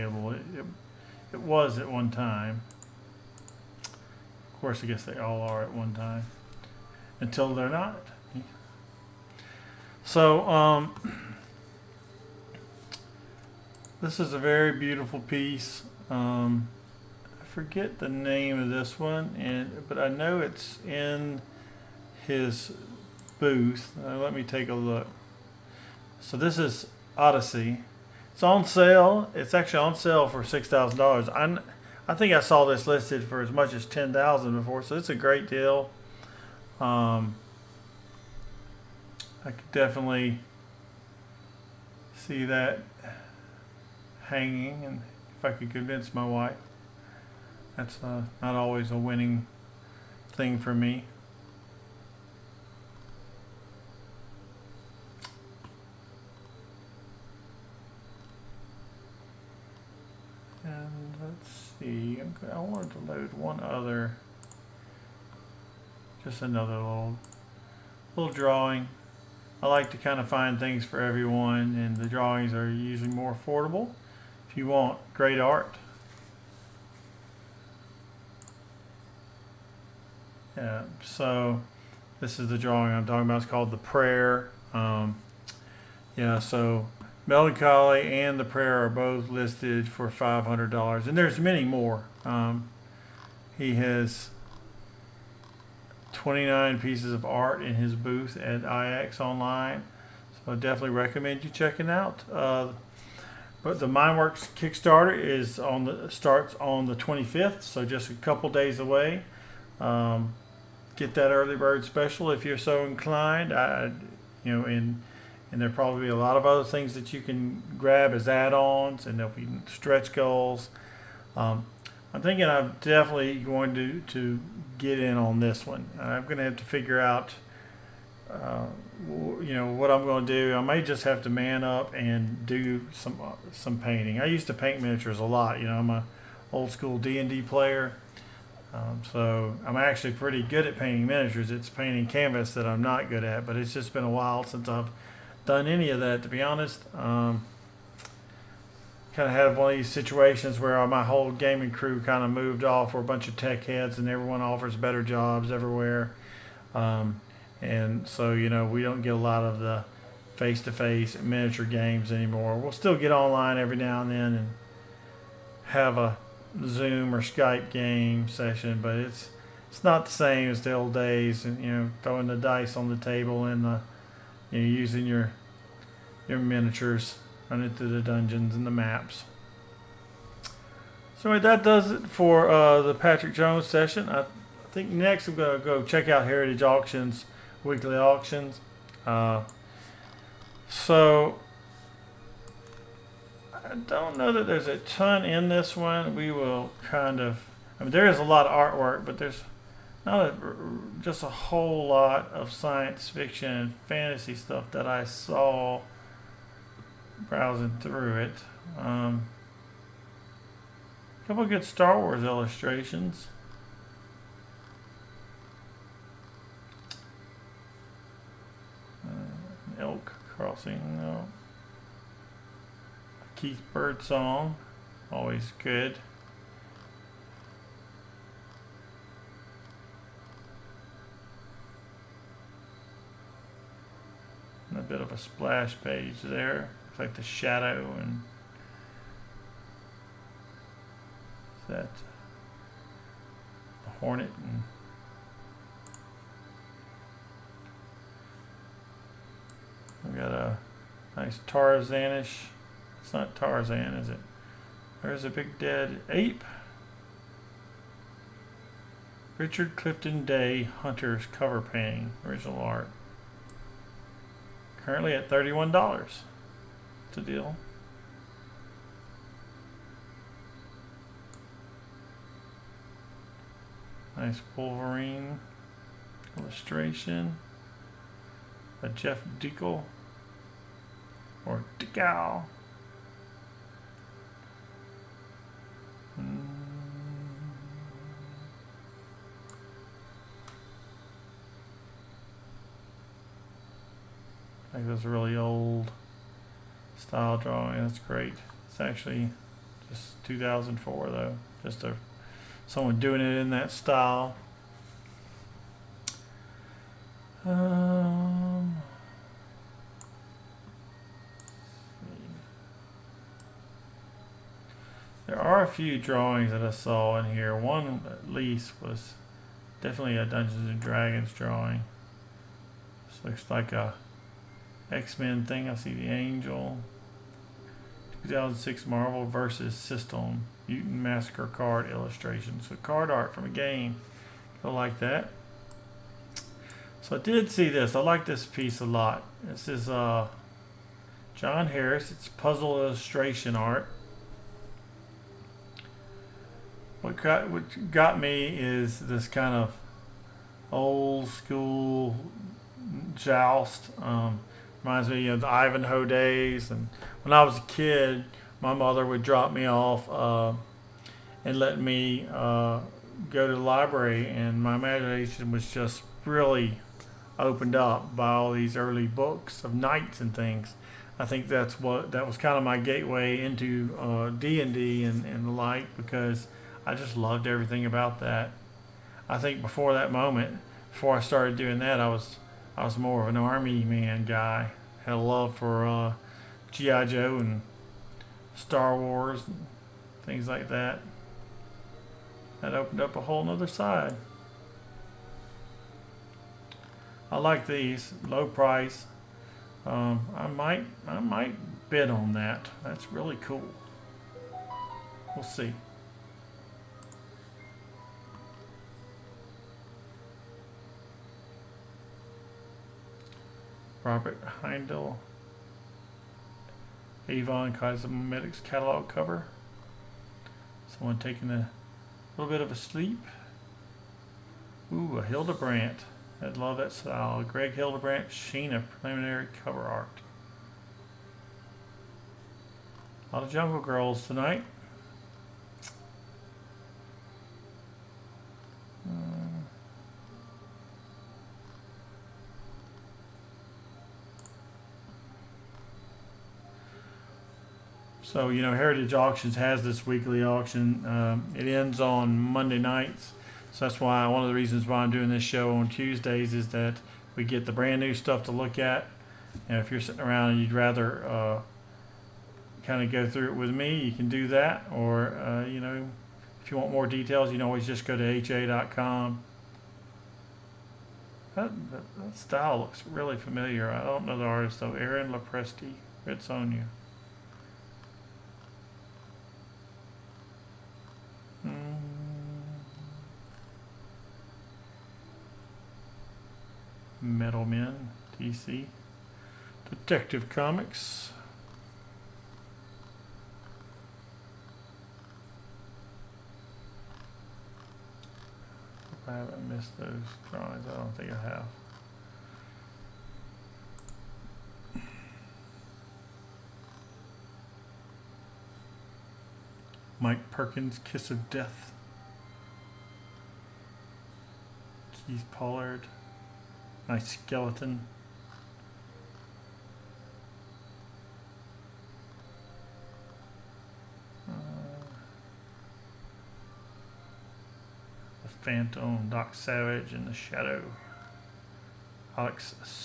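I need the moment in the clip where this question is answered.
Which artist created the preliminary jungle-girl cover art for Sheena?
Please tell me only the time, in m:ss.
7:07.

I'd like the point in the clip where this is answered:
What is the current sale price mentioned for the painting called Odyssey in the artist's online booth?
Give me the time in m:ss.
0:30.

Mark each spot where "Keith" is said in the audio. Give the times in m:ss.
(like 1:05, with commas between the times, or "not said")
3:43, 8:35.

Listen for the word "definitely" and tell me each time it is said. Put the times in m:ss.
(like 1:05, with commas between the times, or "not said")
0:39, 1:40, 2:02, 5:19.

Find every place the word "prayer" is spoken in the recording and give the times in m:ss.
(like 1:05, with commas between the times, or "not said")
1:23, 1:28.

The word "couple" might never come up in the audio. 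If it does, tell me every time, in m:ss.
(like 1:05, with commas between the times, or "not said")
1:48, 3:31.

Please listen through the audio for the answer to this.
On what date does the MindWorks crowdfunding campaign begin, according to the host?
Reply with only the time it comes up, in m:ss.
1:46.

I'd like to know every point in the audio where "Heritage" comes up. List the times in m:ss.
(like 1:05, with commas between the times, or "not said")
3:06, 7:28.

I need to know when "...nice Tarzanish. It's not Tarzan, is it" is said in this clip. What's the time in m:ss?
4:11.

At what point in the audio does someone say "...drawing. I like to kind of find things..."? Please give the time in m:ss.
1:08.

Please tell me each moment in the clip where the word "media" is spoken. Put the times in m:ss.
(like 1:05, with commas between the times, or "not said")
not said.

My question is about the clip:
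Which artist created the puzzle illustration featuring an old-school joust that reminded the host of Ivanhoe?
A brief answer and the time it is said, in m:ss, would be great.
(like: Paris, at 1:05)
John Harris, at 5:41.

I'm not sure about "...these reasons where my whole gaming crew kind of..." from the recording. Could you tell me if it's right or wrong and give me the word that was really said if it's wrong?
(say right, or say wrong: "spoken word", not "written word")
wrong: "situations", not "reasons".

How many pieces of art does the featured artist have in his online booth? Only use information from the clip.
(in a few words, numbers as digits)
29.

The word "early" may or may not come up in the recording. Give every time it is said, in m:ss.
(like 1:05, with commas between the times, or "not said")
1:51, 6:08.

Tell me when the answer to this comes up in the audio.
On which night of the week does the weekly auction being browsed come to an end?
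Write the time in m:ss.
7:32.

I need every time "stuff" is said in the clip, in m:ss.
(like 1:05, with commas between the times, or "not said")
3:24, 7:38.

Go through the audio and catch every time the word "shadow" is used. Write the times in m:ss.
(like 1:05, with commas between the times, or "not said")
3:57, 8:50.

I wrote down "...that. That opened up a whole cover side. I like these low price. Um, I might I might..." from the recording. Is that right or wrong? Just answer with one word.
wrong.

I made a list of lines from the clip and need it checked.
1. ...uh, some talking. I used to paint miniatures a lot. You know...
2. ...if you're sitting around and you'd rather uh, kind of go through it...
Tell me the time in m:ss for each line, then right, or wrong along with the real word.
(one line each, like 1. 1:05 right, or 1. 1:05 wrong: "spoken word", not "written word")
1. 2:13 wrong: "painting", not "talking"
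2. 7:39 right.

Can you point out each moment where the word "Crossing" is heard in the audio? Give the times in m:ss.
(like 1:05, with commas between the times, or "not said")
3:40.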